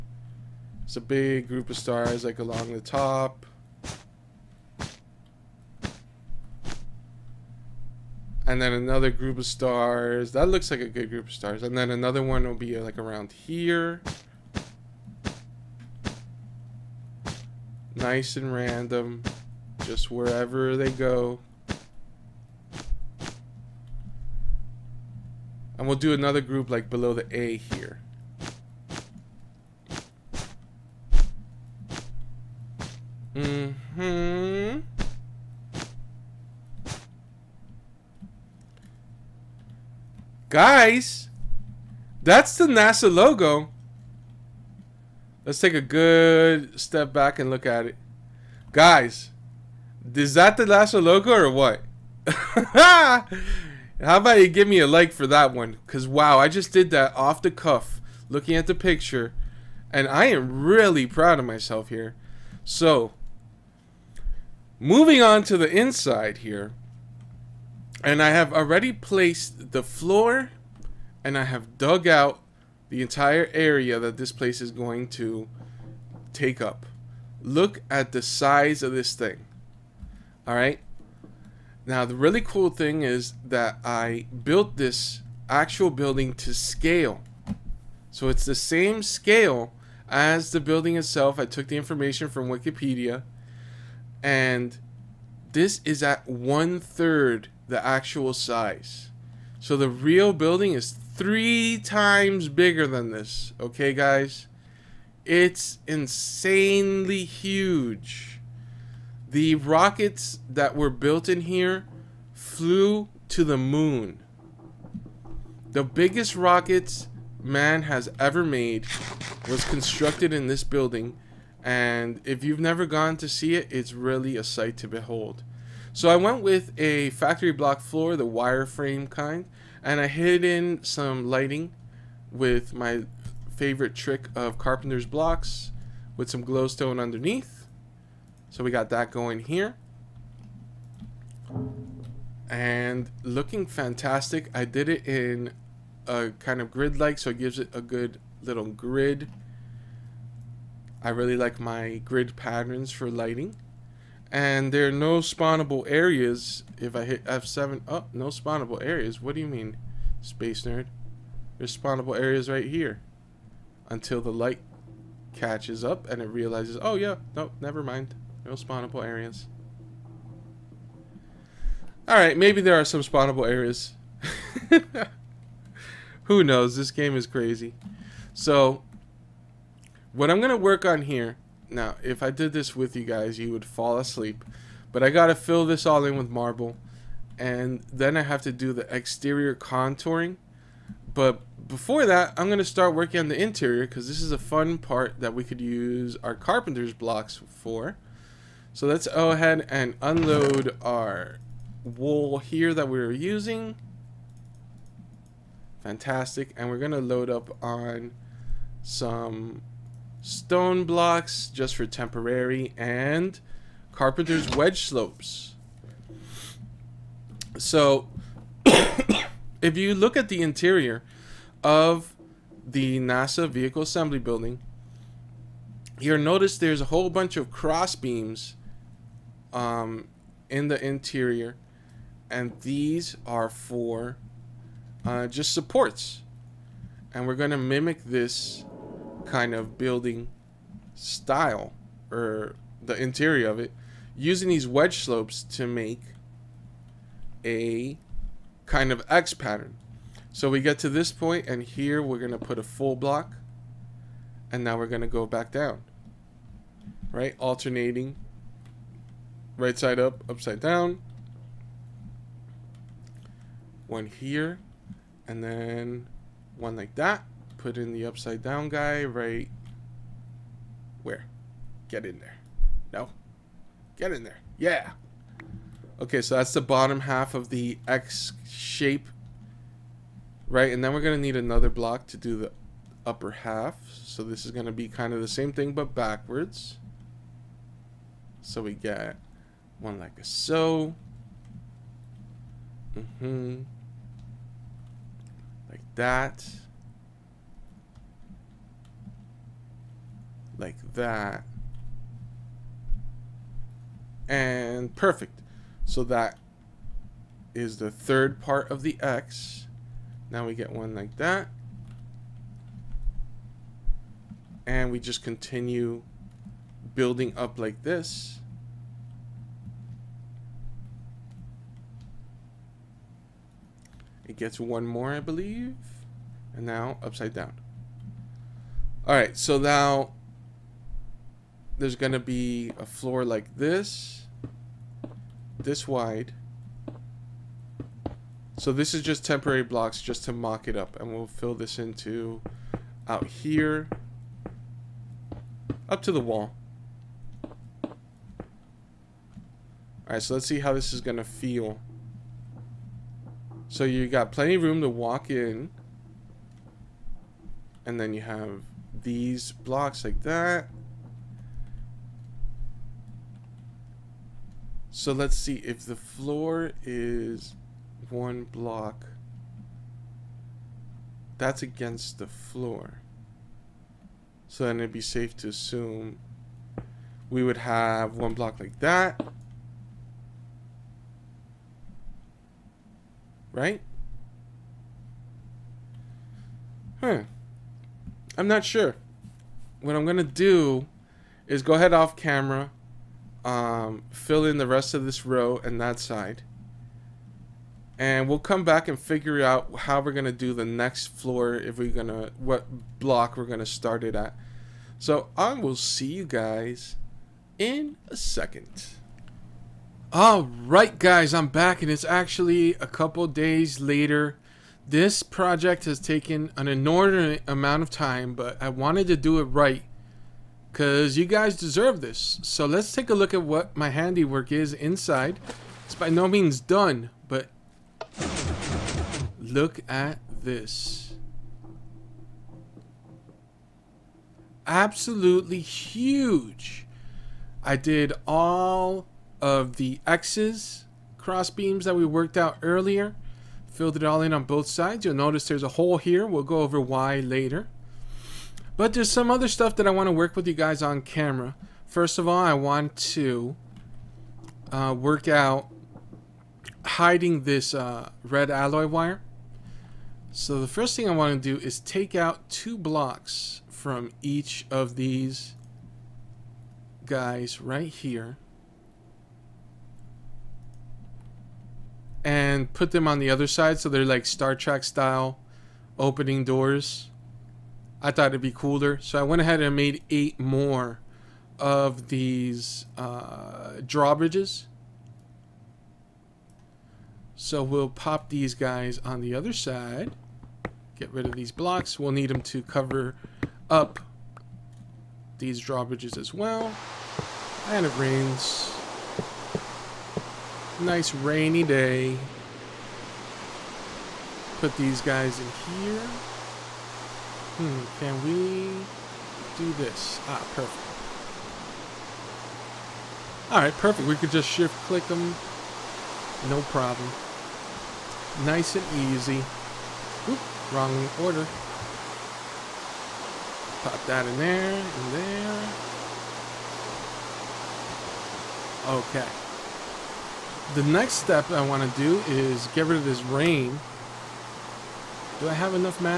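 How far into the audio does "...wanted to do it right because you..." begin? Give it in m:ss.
6:58.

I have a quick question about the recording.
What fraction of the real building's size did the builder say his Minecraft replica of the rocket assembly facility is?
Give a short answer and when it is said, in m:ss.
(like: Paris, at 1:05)
one third, at 1:36.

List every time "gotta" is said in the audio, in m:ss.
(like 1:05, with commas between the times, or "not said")
3:05.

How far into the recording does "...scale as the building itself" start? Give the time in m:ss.
1:29.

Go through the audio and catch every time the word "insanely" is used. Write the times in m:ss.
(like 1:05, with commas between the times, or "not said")
1:45.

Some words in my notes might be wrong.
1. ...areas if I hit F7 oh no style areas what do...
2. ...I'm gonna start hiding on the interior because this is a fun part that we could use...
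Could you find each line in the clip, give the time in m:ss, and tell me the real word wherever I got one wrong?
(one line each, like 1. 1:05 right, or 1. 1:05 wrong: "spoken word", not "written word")
1. 2:35 wrong: "spawnable", not "style"
2. 3:12 wrong: "working", not "hiding".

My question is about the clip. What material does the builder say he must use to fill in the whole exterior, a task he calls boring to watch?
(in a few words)
marble.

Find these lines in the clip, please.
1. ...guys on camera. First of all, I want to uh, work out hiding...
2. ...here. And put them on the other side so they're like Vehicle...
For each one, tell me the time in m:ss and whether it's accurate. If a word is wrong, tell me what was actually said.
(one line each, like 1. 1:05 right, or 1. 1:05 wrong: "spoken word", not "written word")
1. 7:30 right
2. 7:47 wrong: "Star", not "Vehicle".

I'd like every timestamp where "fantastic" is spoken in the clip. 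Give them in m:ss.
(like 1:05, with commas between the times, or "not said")
2:23, 3:25.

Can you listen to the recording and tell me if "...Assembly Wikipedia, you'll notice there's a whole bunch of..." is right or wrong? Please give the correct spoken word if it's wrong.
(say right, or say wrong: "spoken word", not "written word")
wrong: "Building", not "Wikipedia".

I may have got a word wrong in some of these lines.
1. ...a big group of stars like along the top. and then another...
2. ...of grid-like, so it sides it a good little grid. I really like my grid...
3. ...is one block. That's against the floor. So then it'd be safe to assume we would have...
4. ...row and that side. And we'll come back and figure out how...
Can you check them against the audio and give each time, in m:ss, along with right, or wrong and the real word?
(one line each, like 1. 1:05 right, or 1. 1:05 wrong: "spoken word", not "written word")
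1. 0:00 right
2. 2:26 wrong: "gives", not "sides"
3. 6:06 right
4. 6:35 right.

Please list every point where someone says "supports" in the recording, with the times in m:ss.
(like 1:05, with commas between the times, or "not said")
3:55.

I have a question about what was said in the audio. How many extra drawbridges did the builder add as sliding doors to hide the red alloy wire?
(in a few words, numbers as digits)
8.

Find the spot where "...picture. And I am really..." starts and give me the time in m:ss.
0:58.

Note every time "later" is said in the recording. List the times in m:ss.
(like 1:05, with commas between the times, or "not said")
6:53, 7:27.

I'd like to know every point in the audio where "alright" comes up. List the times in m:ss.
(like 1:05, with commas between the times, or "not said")
2:52, 6:50, 8:33.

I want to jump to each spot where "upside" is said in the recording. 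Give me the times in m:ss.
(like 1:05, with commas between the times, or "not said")
4:20, 4:28, 5:27.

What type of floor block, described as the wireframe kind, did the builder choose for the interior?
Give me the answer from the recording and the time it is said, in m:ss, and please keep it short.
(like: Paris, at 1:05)
factory block, at 2:07.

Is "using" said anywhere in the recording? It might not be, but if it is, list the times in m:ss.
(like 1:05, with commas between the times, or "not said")
3:23, 4:04.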